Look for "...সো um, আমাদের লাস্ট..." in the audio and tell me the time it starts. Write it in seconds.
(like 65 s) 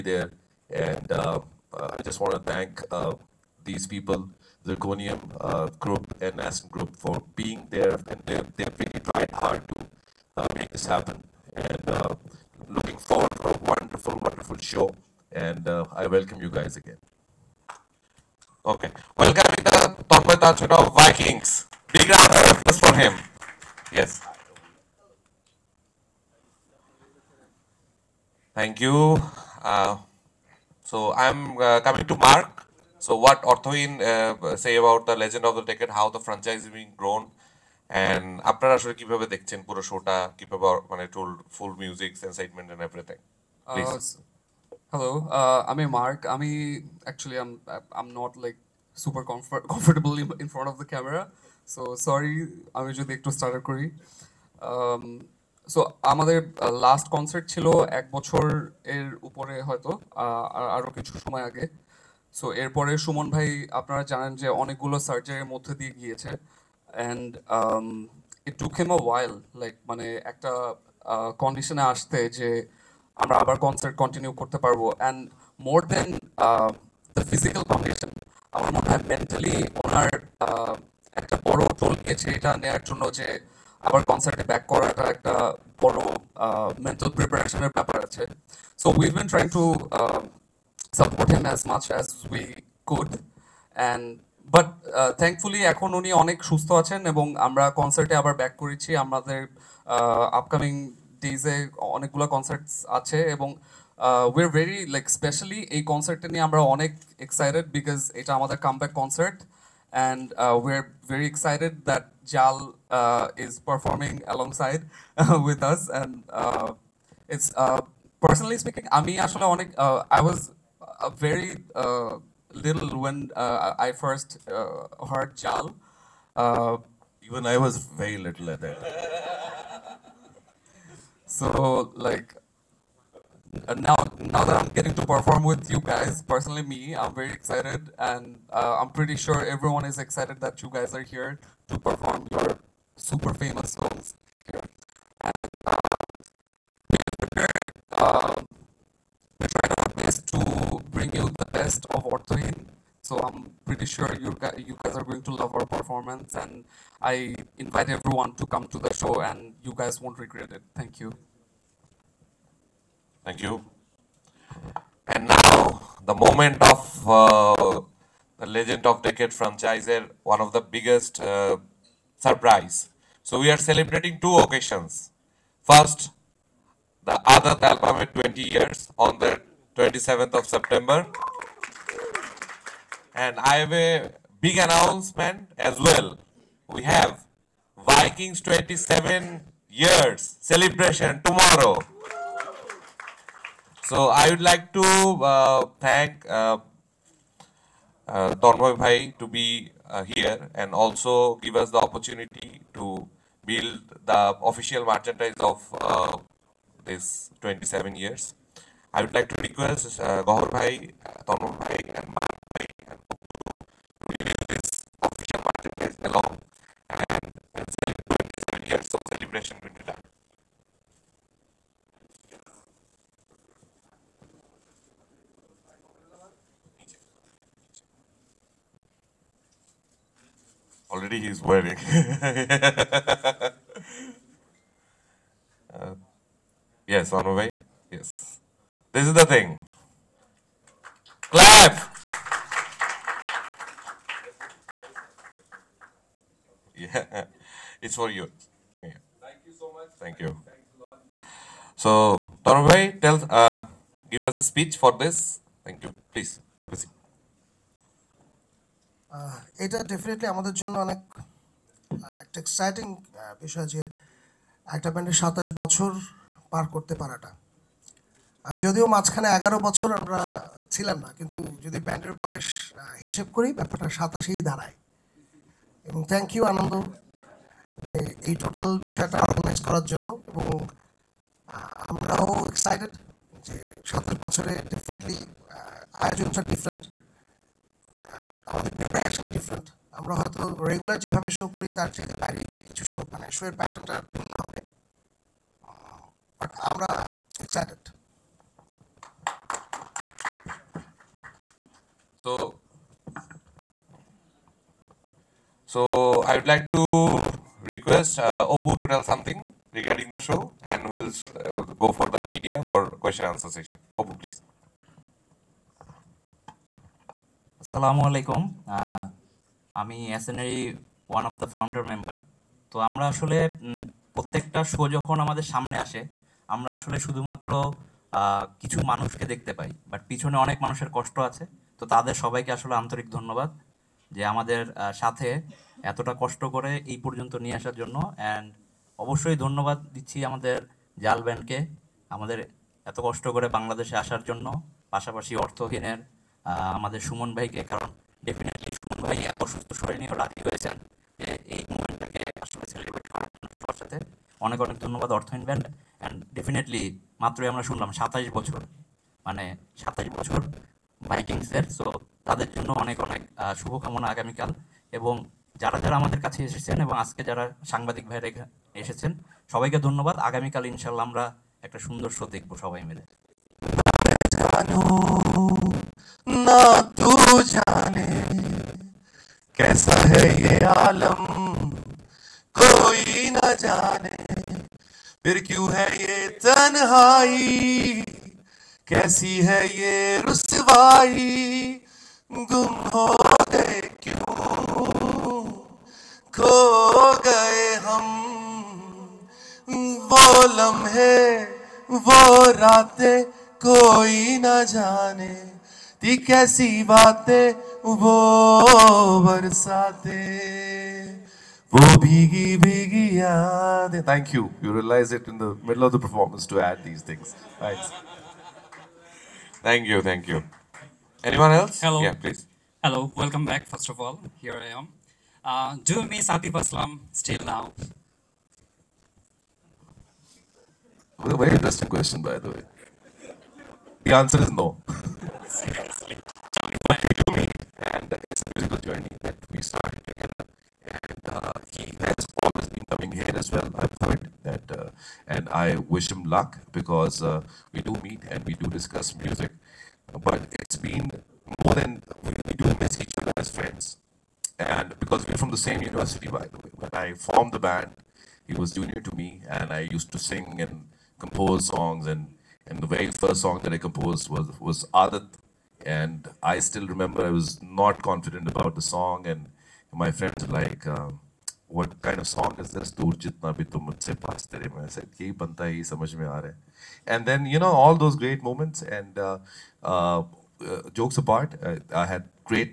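55 s.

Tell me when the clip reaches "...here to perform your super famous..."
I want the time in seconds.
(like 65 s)
141 s.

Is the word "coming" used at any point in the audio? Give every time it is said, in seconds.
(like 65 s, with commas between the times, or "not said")
31 s, 442 s.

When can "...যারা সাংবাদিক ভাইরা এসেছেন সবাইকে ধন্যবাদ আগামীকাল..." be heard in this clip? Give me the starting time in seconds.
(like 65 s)
367 s.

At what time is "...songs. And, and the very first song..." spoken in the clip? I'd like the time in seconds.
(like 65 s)
461 s.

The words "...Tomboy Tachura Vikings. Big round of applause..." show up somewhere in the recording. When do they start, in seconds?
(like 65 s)
20 s.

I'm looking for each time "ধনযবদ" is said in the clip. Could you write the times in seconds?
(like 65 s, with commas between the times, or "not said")
333 s, 339 s, 354 s, 369 s.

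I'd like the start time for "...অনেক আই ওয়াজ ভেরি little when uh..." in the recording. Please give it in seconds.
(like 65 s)
119 s.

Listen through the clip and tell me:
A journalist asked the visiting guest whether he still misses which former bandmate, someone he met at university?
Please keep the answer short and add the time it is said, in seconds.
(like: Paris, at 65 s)
Atif Aslam, at 426 s.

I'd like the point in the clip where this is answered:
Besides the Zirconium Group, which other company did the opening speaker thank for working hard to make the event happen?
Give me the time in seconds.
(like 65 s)
6 s.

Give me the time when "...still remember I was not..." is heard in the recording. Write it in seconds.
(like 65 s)
466 s.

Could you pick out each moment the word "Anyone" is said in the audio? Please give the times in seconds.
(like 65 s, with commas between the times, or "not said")
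421 s.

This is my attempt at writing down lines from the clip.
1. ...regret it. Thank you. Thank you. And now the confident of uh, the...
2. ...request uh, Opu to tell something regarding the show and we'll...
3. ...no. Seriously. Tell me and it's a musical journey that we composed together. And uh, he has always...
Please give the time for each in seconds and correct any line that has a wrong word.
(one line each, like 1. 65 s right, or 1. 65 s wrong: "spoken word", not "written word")
1. 160 s wrong: "moment", not "confident"
2. 307 s right
3. 434 s wrong: "started", not "composed".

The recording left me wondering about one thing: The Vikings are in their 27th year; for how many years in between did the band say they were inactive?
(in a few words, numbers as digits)
11 years.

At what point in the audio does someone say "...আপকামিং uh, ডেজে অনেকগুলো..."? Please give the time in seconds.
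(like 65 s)
100 s.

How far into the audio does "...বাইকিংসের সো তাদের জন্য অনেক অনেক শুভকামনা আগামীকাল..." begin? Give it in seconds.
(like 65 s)
361 s.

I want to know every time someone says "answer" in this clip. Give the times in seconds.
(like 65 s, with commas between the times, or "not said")
313 s, 434 s.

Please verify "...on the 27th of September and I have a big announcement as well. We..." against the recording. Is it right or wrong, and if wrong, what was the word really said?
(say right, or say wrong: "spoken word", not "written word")
right.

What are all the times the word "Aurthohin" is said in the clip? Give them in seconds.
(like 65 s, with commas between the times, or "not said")
33 s.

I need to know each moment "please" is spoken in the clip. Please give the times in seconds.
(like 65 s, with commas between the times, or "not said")
256 s, 314 s, 422 s.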